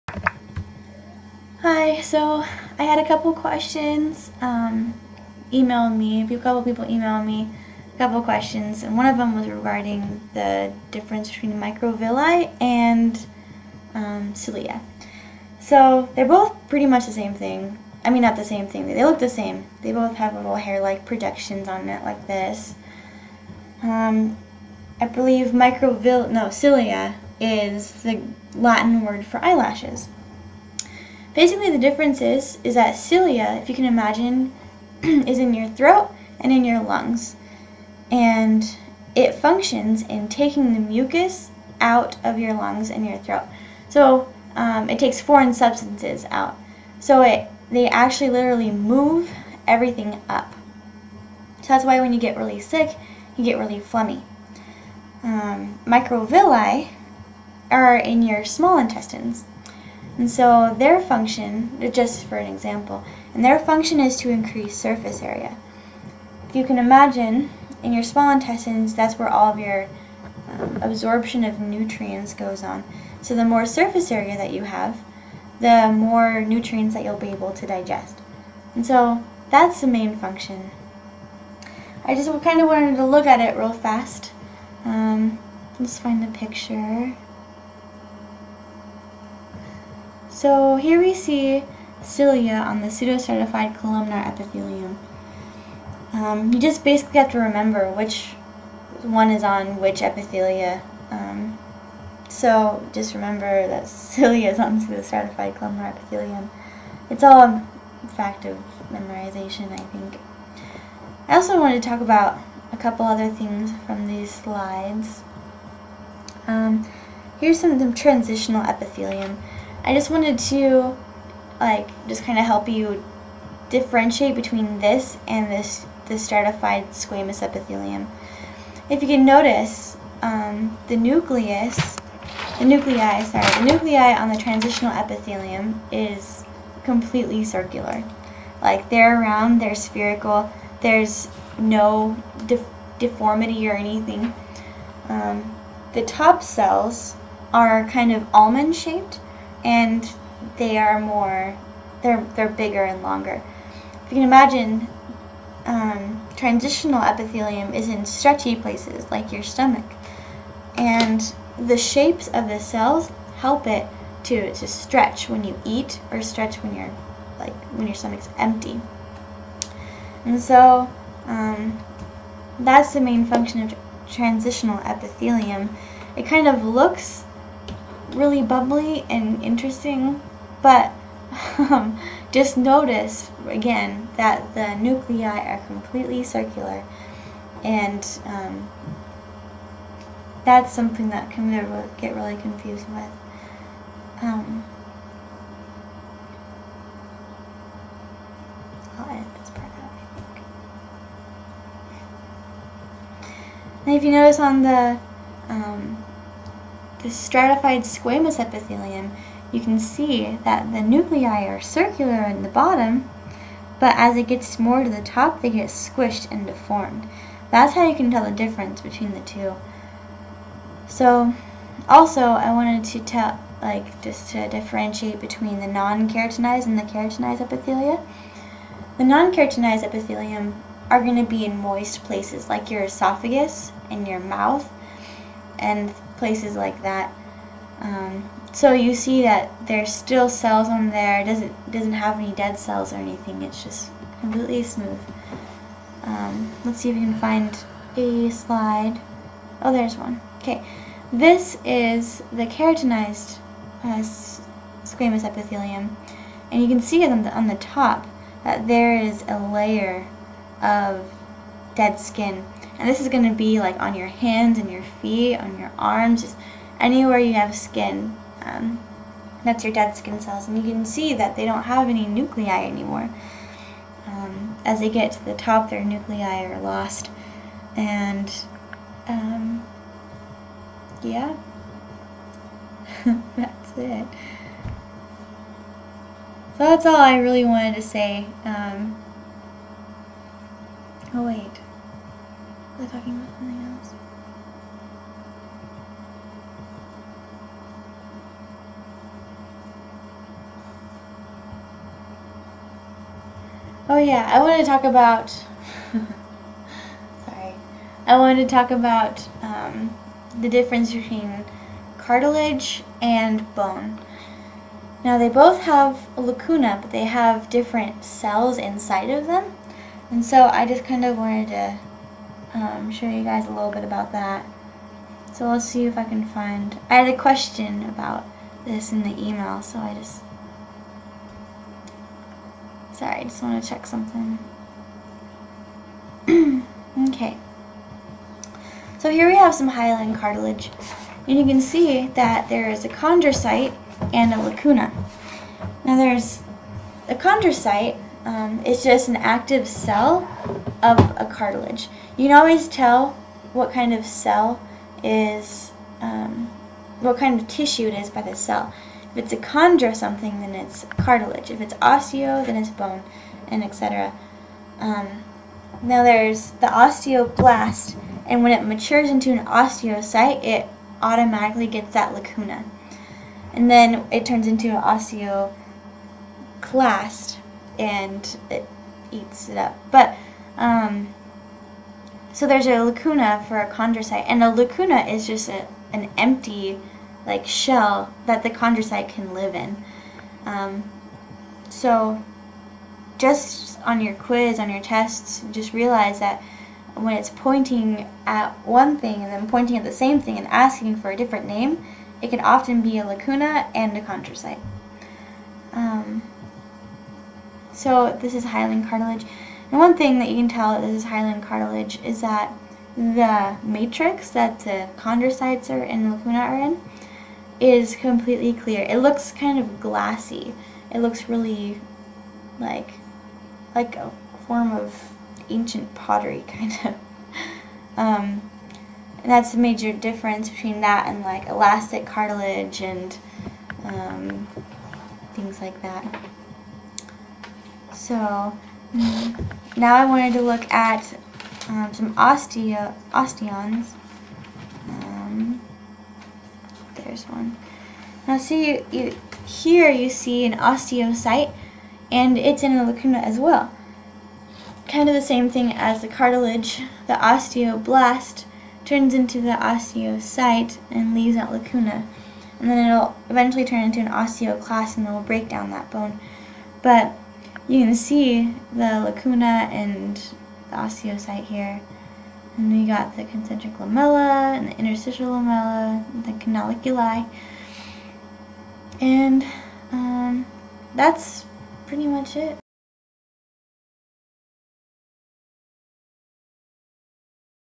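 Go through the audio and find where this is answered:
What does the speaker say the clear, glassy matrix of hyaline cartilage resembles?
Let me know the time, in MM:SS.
07:05.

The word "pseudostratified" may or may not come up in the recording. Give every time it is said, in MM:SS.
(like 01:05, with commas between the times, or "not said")
01:32, 01:44.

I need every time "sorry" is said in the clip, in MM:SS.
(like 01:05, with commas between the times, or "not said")
02:13, 05:07, 05:32.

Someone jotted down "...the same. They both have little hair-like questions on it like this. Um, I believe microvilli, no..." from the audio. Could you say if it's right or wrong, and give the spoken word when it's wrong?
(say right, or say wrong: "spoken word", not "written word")
wrong: "projections", not "questions".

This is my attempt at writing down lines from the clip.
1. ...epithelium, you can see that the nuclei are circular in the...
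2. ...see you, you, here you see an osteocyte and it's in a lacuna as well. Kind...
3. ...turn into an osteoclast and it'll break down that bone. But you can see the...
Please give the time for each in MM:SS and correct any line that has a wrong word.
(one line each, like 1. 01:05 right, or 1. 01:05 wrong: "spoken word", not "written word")
1. 03:28 right
2. 07:28 right
3. 07:43 right.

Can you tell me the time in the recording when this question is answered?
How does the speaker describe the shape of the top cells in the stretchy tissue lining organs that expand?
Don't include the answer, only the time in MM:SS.
02:28.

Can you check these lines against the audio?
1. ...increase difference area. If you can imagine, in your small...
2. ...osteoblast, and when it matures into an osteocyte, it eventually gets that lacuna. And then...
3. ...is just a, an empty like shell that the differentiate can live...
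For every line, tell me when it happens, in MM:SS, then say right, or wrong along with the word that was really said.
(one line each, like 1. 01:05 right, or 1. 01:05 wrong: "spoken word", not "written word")
1. 01:04 wrong: "surface", not "difference"
2. 06:06 wrong: "automatically", not "eventually"
3. 06:25 wrong: "chondrocyte", not "differentiate".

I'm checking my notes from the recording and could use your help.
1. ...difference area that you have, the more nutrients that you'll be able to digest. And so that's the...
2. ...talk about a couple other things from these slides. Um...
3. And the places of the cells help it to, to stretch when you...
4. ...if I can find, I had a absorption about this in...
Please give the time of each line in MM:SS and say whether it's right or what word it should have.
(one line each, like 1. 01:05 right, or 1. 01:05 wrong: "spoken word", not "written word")
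1. 01:13 wrong: "surface", not "difference"
2. 01:51 right
3. 02:40 wrong: "shapes", not "places"
4. 05:25 wrong: "question", not "absorption".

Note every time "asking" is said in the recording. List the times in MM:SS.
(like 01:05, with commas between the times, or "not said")
06:40.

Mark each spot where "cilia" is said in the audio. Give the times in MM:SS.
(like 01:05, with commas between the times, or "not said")
00:14, 00:26, 00:32, 01:32, 01:43.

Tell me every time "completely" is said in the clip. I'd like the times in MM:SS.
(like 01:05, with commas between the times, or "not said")
02:16, 03:05, 04:04, 06:57.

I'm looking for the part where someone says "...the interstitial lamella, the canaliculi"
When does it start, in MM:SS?
07:54.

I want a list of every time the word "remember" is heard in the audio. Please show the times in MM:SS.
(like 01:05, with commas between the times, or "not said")
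01:37, 01:43.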